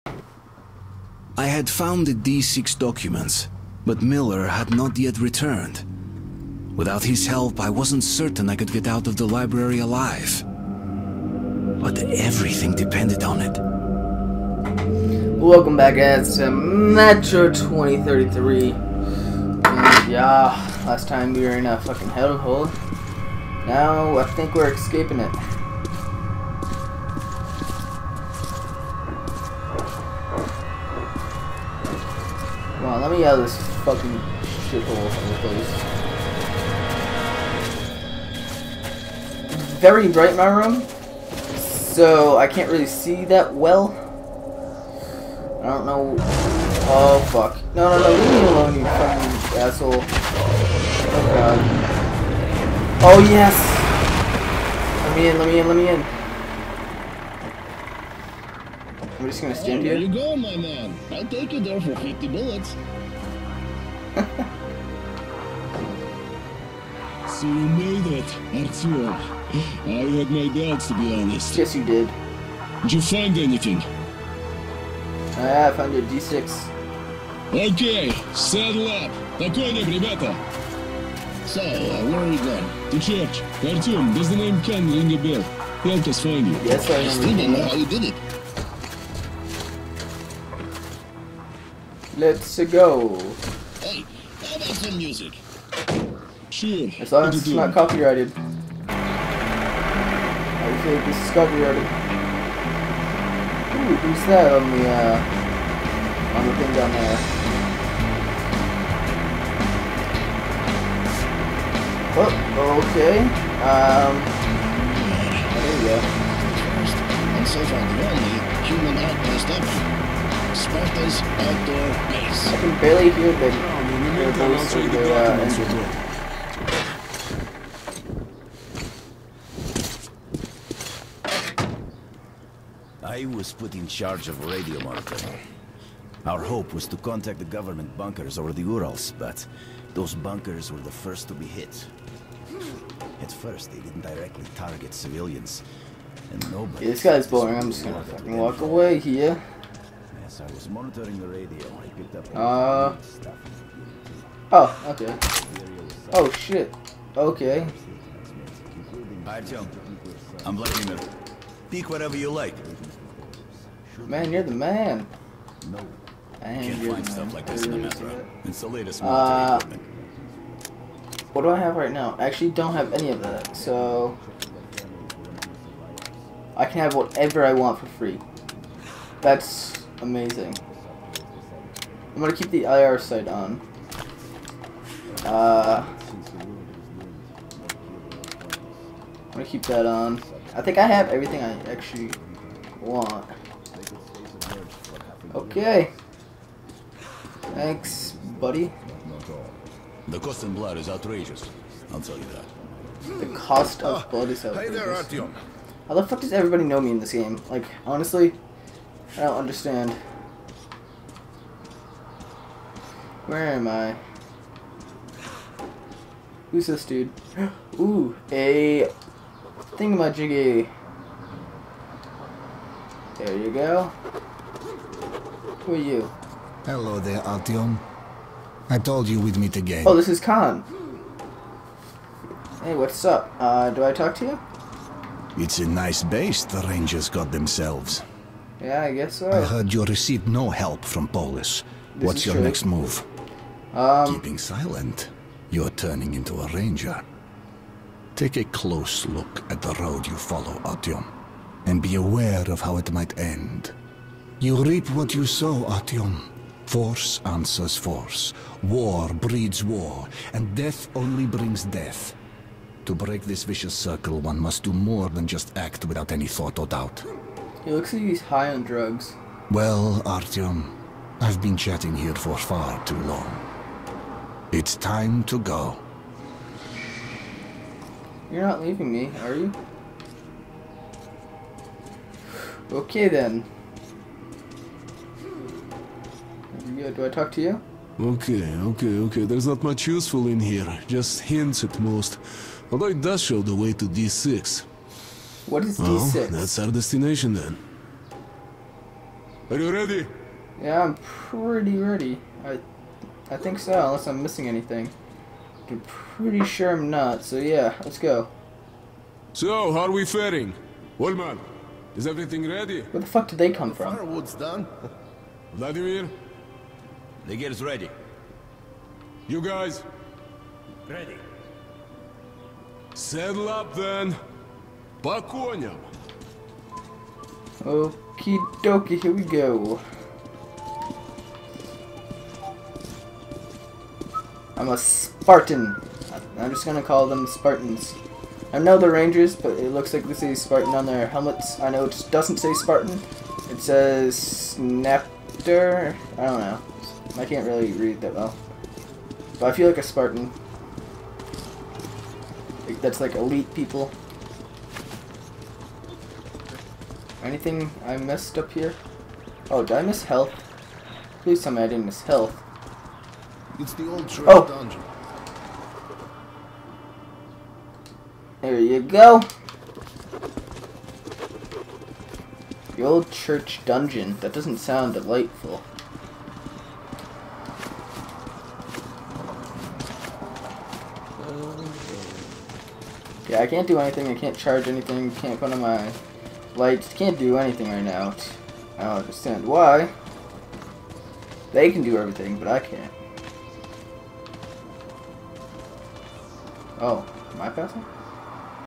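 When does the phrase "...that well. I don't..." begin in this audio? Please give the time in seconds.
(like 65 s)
43 s.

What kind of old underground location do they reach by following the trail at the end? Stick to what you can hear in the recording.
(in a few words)
church dungeon.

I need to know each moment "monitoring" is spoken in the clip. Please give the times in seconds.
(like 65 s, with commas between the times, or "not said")
134 s, 150 s.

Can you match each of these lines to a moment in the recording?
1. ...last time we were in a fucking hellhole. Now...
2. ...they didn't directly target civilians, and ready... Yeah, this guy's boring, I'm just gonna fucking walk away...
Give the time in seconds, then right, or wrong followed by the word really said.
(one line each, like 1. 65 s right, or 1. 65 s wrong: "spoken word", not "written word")
1. 20 s right
2. 143 s wrong: "nobody", not "ready".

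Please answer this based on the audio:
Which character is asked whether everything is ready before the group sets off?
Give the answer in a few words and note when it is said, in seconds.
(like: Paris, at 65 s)
Ulman, at 310 s.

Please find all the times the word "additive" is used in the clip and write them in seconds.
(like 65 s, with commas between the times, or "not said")
not said.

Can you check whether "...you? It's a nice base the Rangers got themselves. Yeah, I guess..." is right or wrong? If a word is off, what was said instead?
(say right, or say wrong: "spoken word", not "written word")
right.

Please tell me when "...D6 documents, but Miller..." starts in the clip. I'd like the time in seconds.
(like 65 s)
2 s.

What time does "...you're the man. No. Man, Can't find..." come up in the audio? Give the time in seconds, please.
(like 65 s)
164 s.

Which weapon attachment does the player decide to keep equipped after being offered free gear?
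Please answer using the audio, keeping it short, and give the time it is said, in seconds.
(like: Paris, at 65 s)
IR sight, at 182 s.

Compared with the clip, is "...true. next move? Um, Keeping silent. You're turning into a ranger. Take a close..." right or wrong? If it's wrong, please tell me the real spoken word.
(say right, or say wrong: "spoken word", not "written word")
right.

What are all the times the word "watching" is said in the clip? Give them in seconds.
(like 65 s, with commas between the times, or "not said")
not said.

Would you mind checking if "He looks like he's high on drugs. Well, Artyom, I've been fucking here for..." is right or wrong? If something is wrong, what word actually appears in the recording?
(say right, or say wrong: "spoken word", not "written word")
wrong: "chatting", not "fucking".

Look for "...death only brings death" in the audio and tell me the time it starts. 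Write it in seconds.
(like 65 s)
260 s.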